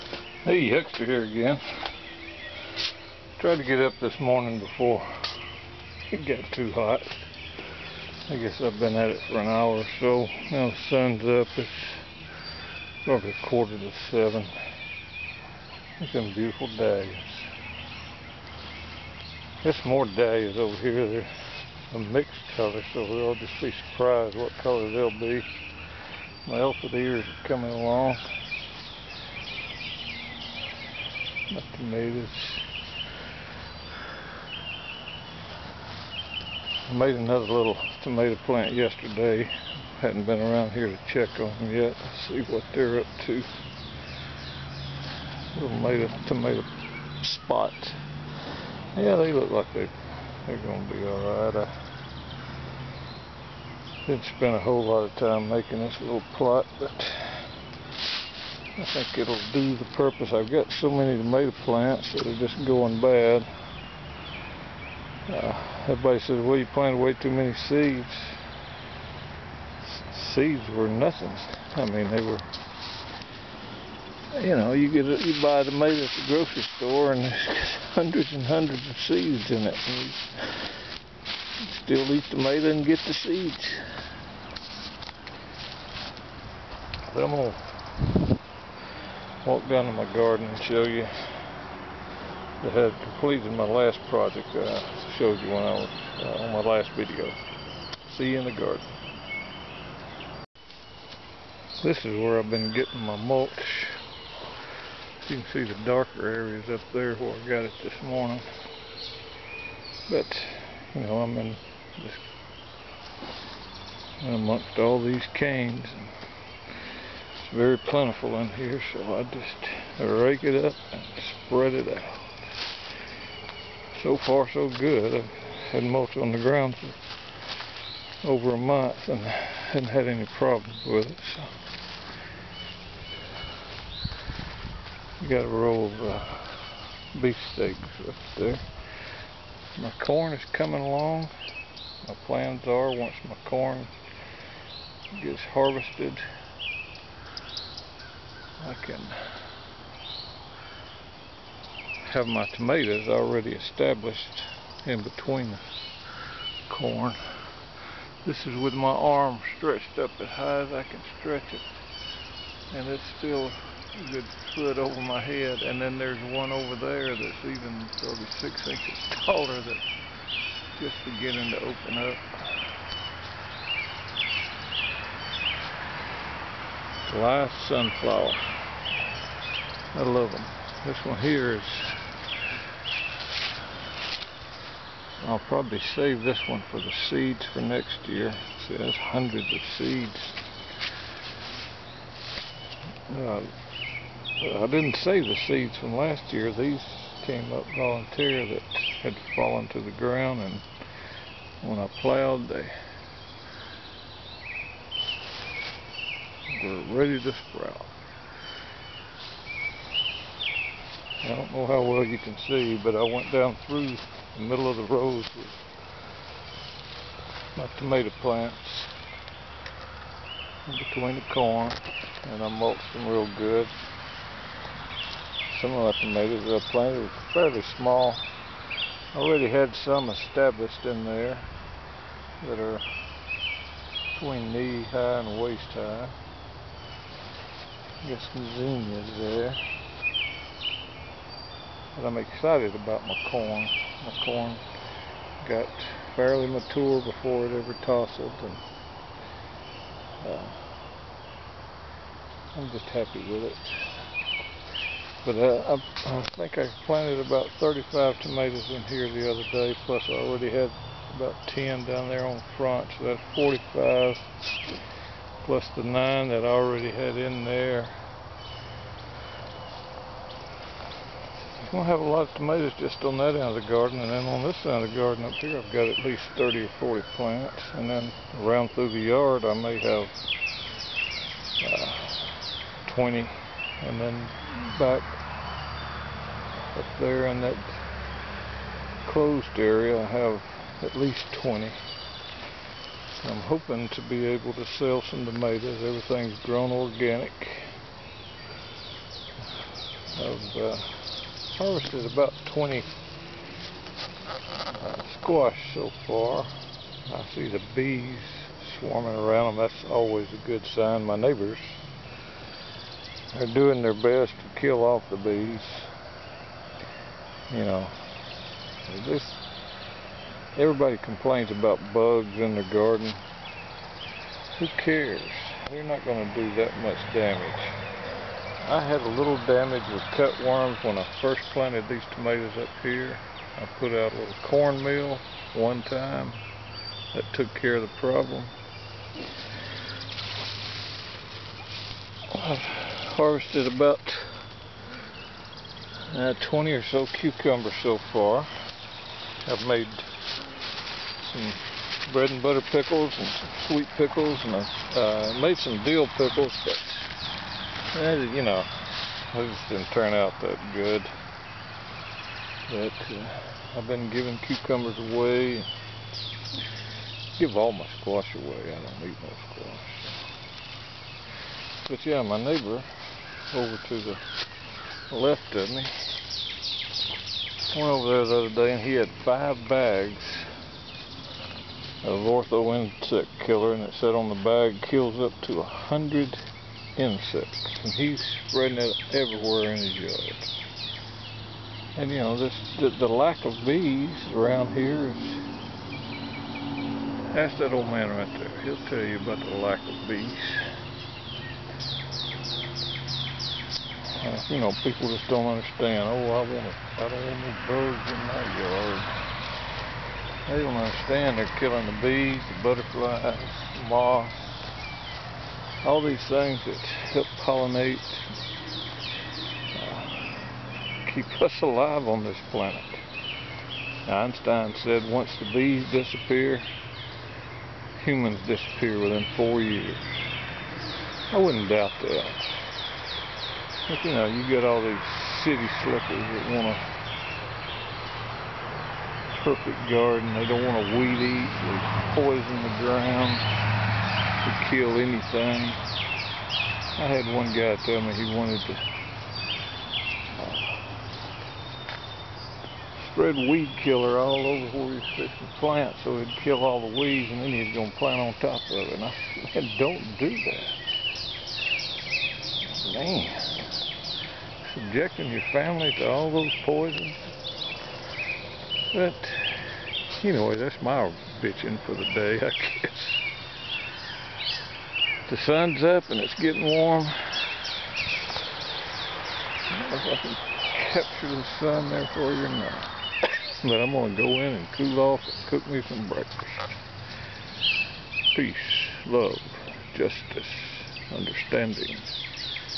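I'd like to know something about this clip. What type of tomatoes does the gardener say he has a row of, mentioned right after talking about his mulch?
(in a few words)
beefsteaks.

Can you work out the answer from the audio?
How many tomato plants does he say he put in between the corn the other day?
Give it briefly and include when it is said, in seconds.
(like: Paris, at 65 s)
35, at 257 s.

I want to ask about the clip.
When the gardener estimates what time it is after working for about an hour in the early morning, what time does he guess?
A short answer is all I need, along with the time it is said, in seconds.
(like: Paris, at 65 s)
quarter to seven, at 13 s.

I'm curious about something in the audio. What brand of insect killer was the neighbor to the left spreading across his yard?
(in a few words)
Ortho.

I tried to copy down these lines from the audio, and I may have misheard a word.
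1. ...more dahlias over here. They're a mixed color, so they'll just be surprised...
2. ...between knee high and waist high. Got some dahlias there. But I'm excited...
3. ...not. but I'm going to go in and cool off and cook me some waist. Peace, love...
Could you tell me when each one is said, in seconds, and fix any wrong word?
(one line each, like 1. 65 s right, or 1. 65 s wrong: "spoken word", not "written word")
1. 19 s right
2. 234 s wrong: "zinnias", not "dahlias"
3. 482 s wrong: "breakfast", not "waist".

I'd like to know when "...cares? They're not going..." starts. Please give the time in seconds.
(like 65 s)
324 s.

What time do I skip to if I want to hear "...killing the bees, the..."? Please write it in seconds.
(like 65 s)
411 s.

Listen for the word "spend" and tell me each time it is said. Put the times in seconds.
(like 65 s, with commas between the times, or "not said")
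54 s.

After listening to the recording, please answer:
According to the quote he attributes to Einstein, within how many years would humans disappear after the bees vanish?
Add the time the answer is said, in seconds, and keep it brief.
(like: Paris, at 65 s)
4, at 429 s.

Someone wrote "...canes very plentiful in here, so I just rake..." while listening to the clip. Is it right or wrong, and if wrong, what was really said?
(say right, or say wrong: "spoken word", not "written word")
right.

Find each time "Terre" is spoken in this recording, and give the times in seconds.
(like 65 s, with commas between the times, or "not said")
not said.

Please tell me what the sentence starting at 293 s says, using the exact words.
I'm hoping to be able to sell some tomatoes.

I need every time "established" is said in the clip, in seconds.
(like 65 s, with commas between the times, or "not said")
153 s, 230 s.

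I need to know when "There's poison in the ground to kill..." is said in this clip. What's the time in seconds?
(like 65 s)
441 s.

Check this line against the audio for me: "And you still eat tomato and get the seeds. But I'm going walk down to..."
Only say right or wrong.
right.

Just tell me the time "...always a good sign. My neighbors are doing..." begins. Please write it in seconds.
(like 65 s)
309 s.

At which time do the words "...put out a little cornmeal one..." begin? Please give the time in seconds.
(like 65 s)
333 s.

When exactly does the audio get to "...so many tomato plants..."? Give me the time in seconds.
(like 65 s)
60 s.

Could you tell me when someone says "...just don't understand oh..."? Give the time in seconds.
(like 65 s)
405 s.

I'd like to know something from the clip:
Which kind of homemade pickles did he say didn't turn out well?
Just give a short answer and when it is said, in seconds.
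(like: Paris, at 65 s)
dill pickles, at 355 s.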